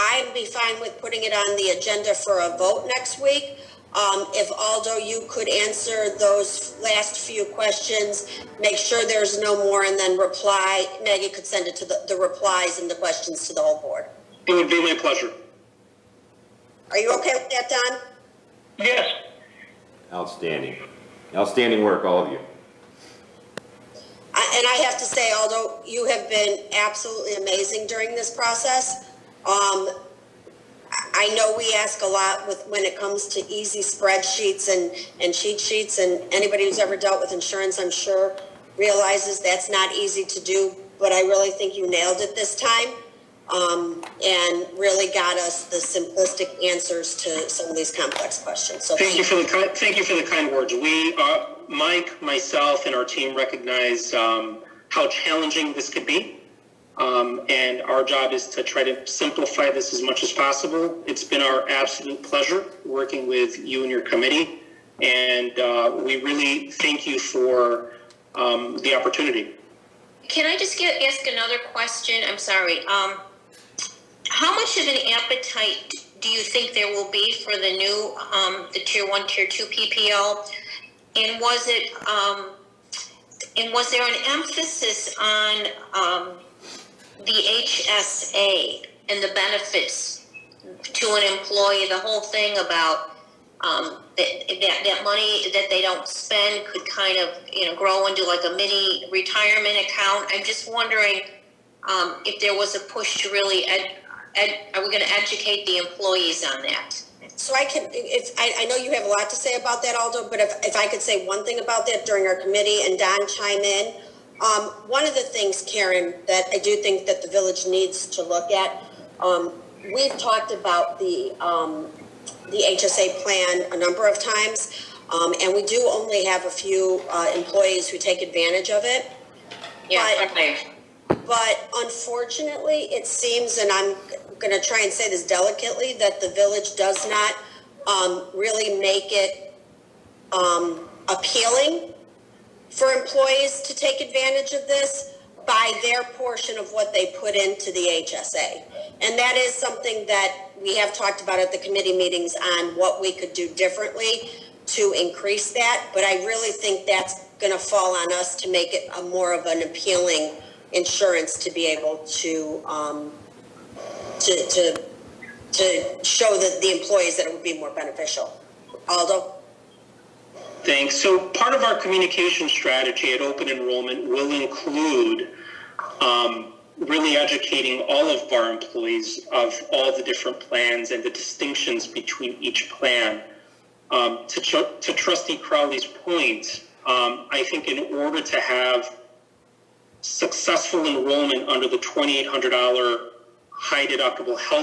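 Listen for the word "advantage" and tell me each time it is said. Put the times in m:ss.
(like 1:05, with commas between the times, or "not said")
2:08, 2:24.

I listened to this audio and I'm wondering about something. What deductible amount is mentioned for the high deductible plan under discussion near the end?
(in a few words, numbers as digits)
$2,800.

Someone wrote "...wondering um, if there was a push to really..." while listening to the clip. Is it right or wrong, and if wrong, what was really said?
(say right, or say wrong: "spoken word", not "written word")
right.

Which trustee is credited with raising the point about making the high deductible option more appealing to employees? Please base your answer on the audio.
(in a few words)
Trustee Crowley.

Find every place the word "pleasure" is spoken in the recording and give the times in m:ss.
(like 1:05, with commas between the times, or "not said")
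0:14, 1:02.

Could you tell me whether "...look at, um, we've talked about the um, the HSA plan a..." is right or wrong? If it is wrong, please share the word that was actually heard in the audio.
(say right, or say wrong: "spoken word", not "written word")
right.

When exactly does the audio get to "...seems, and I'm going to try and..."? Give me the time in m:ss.
2:13.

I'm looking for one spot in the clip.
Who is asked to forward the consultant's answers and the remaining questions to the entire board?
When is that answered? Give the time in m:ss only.
0:11.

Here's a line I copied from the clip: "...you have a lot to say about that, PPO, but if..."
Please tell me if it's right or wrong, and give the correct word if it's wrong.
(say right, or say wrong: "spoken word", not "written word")
wrong: "Aldo", not "PPO".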